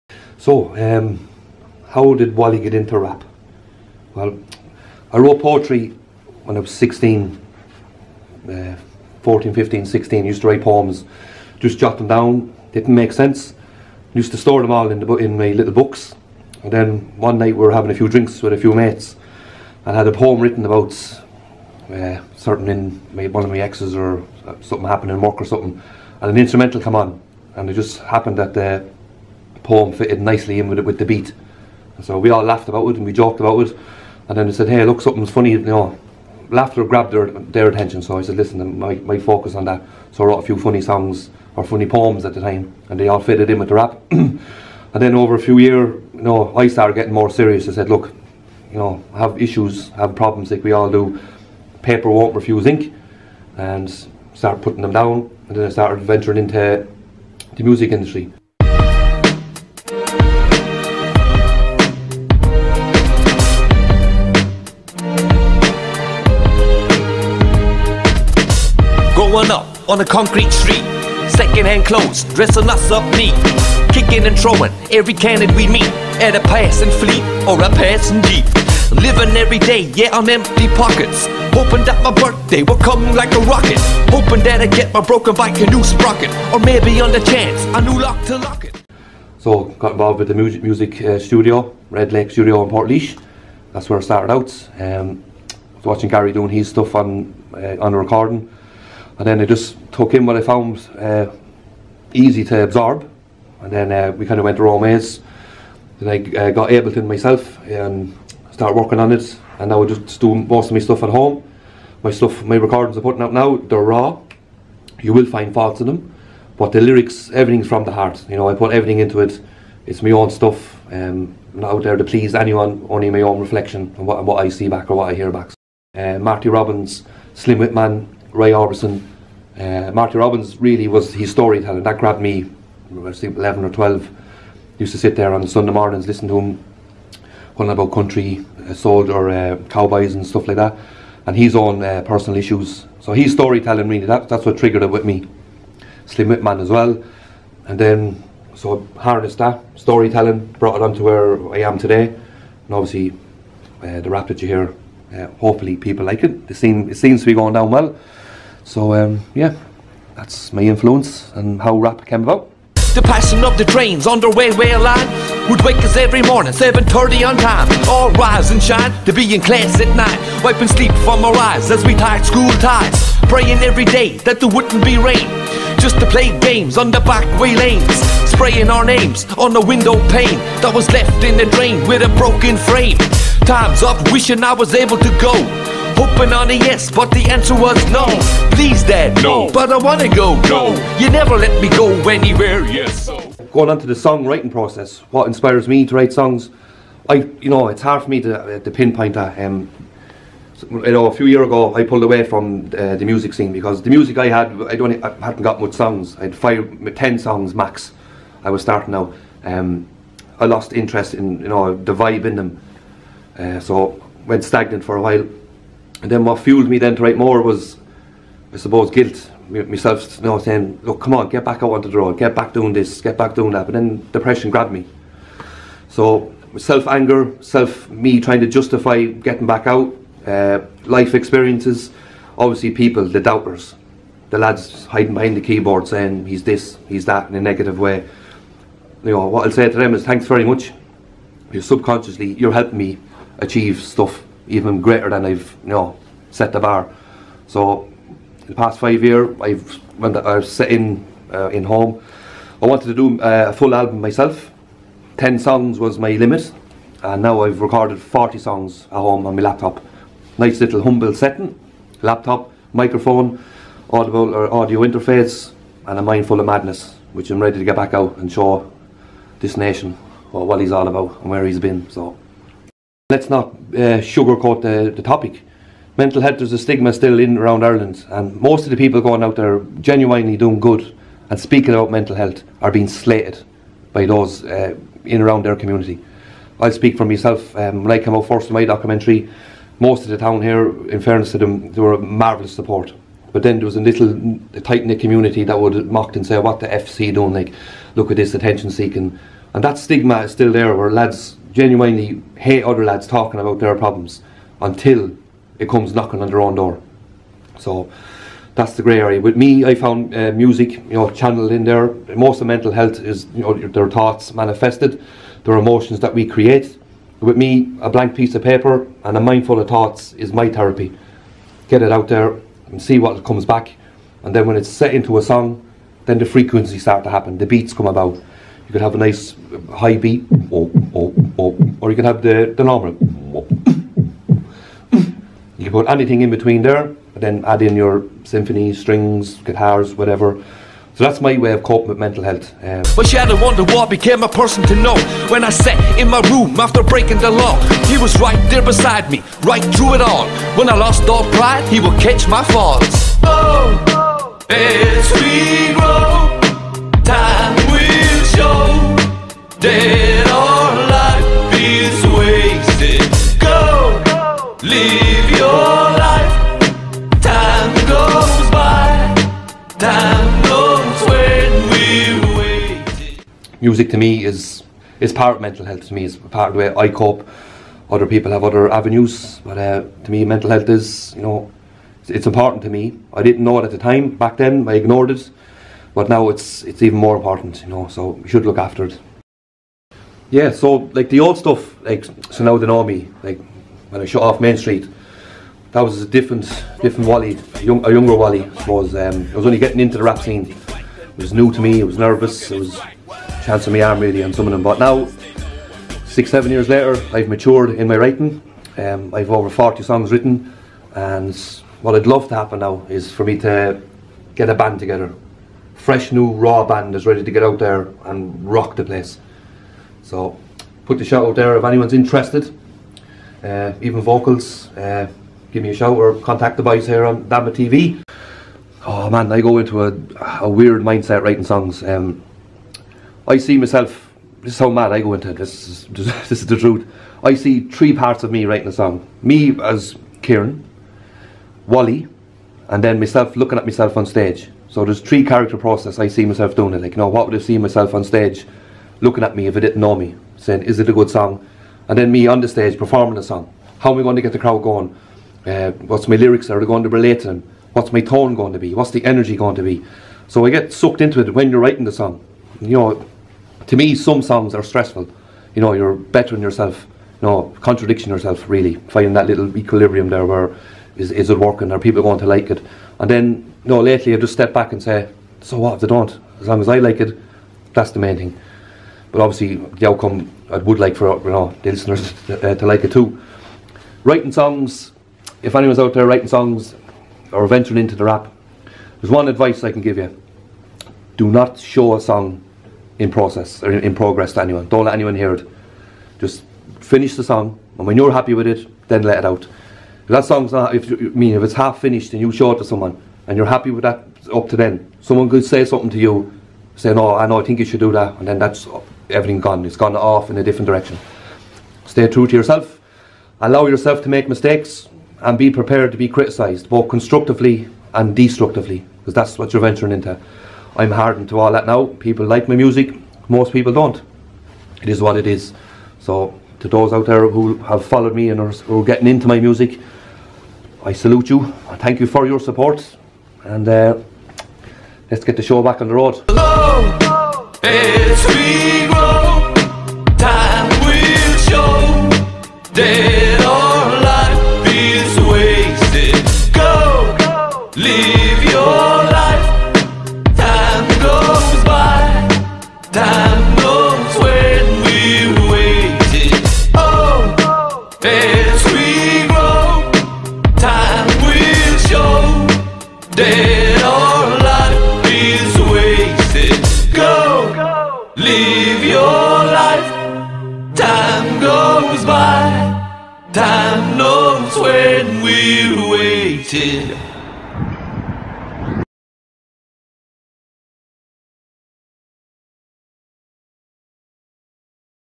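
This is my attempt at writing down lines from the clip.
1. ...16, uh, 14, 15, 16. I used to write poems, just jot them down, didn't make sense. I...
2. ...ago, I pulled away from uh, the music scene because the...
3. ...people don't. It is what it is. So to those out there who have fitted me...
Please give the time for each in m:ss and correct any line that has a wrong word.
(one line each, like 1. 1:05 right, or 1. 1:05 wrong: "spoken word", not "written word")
1. 0:06 right
2. 3:21 right
3. 8:43 wrong: "followed", not "fitted".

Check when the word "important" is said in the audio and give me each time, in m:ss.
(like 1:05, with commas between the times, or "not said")
6:22, 6:27.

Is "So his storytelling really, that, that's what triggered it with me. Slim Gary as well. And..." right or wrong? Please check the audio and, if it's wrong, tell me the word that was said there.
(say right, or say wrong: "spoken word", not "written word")
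wrong: "Whitman", not "Gary".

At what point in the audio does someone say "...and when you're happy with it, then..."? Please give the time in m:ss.
8:17.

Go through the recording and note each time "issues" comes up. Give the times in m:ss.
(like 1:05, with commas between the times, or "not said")
0:49, 2:22.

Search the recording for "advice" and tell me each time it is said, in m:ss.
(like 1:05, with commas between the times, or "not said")
8:09.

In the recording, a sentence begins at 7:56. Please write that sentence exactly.
As long as I like it, that's the main thing.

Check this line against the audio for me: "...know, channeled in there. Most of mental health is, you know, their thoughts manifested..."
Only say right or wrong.
right.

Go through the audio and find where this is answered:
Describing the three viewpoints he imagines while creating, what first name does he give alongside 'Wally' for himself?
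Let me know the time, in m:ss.
7:20.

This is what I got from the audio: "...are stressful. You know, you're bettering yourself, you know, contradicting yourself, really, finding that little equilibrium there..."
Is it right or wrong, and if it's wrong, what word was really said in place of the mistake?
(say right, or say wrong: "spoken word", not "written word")
right.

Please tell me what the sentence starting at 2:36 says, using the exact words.
It scene, it seems to be going down well.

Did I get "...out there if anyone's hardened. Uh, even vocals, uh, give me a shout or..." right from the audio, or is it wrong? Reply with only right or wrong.
wrong.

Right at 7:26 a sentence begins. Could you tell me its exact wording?
Like, you know, what would I see myself on stage looking at me if I didn't know me?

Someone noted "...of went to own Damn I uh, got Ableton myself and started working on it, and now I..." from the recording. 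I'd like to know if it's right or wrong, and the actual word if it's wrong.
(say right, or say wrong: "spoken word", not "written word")
wrong: "Then", not "Damn".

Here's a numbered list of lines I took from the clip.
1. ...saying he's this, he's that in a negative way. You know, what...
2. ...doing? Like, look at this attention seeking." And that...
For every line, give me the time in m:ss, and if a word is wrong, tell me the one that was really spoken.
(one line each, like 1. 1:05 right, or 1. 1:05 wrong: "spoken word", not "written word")
1. 3:55 right
2. 4:57 right.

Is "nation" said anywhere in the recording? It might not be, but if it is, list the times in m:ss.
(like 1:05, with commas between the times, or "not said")
4:29.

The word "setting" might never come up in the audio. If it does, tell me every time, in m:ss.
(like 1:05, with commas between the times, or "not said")
4:21.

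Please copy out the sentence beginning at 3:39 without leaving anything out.
Myself, you know, saying, look, come on, get back out onto the road, get back doing this, get back doing that.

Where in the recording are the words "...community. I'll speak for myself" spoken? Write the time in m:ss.
4:45.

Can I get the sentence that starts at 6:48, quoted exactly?
Um, I've over 40 songs written, and what I'd love to happen now is for me to get a band together.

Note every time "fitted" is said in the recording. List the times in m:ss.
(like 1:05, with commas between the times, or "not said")
0:29, 0:43.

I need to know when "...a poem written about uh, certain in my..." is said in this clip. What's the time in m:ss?
0:20.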